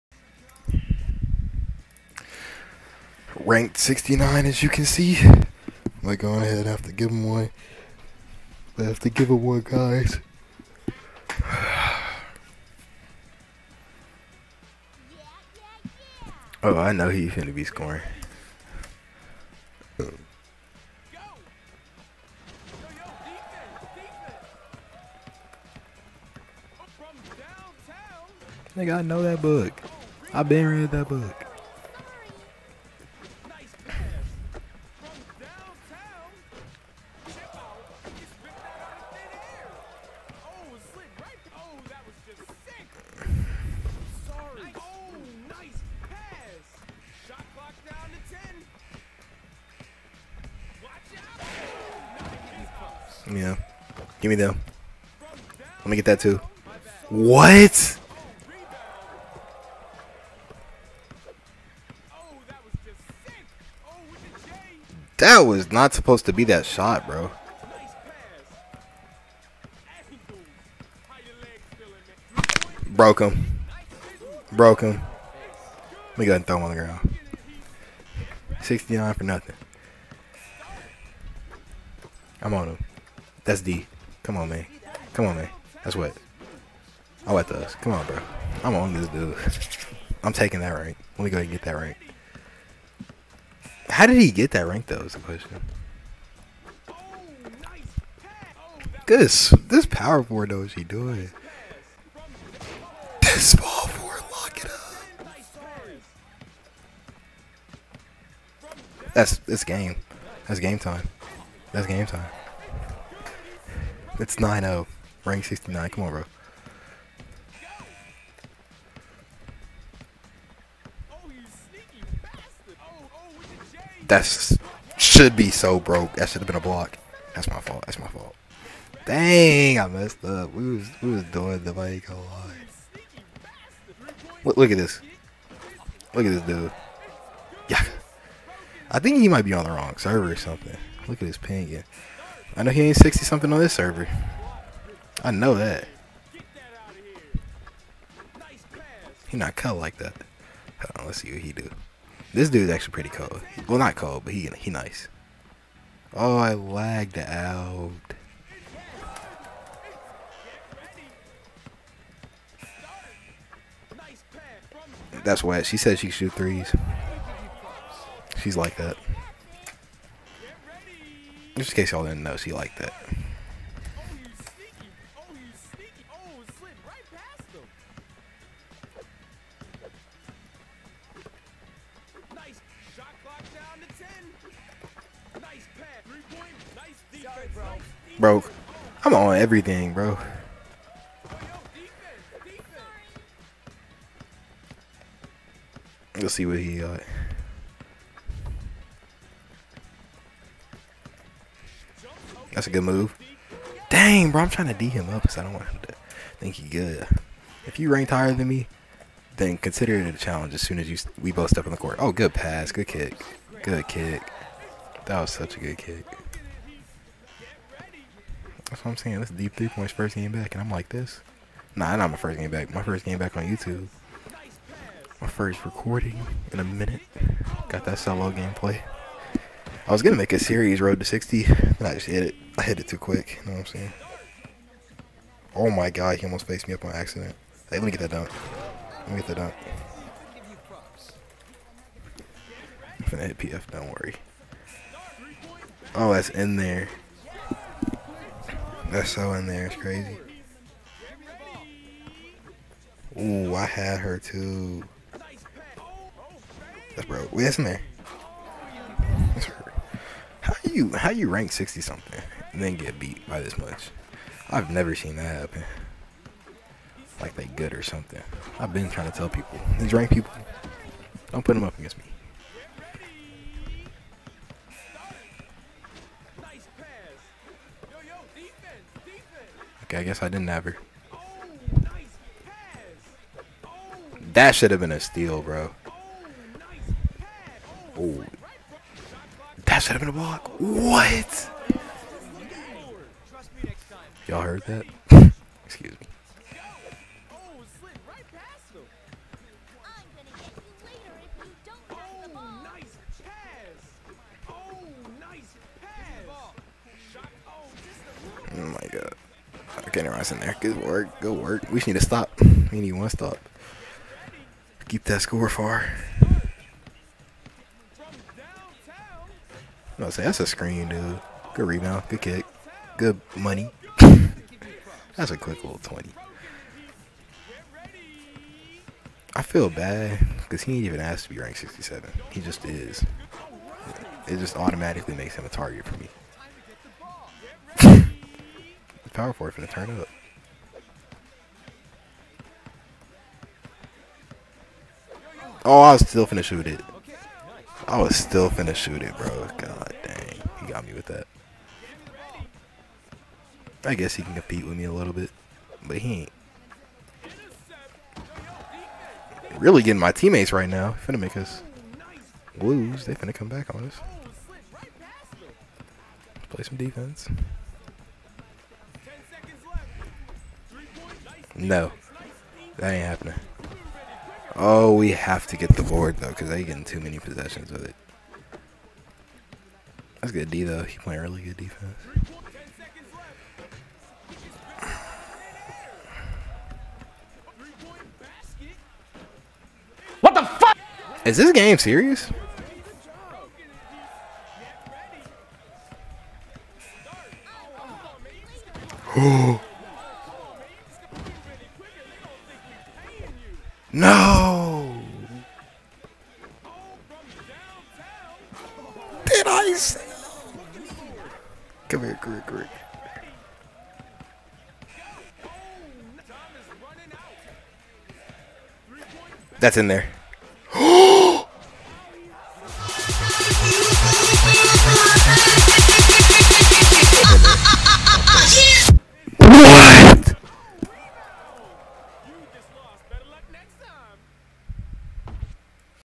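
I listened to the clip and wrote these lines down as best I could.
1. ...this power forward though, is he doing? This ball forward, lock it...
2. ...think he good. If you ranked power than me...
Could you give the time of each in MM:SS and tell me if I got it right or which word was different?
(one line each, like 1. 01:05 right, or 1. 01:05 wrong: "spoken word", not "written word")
1. 01:39 right
2. 03:26 wrong: "higher", not "power".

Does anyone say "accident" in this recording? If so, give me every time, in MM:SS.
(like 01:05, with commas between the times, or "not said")
03:56.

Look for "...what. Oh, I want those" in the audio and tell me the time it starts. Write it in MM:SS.
01:25.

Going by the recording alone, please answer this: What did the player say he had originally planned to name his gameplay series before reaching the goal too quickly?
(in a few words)
road to 60.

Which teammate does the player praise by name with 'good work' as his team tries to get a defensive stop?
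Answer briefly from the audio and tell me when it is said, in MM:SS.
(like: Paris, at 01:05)
Ross, at 05:10.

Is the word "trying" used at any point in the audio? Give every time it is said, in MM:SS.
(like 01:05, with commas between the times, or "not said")
03:24, 04:28.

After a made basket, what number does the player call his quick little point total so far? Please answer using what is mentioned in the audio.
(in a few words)
twenty.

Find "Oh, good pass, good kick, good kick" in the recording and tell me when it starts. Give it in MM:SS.
03:31.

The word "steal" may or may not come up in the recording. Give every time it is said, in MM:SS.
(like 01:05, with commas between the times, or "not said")
04:44.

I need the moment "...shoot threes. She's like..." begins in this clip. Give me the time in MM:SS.
02:46.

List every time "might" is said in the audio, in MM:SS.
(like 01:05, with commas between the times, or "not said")
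02:19.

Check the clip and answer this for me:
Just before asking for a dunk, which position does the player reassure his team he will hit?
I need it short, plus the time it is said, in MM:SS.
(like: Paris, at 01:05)
PF, at 04:03.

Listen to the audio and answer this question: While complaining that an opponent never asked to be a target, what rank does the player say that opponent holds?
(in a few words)
67.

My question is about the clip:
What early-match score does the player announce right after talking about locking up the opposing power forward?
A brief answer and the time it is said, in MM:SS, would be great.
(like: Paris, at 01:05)
9-0, at 01:54.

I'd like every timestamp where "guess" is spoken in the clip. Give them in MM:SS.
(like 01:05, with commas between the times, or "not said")
04:40, 05:53.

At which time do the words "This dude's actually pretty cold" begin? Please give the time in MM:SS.
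02:32.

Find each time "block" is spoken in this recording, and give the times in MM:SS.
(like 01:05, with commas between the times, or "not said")
02:06, 04:50.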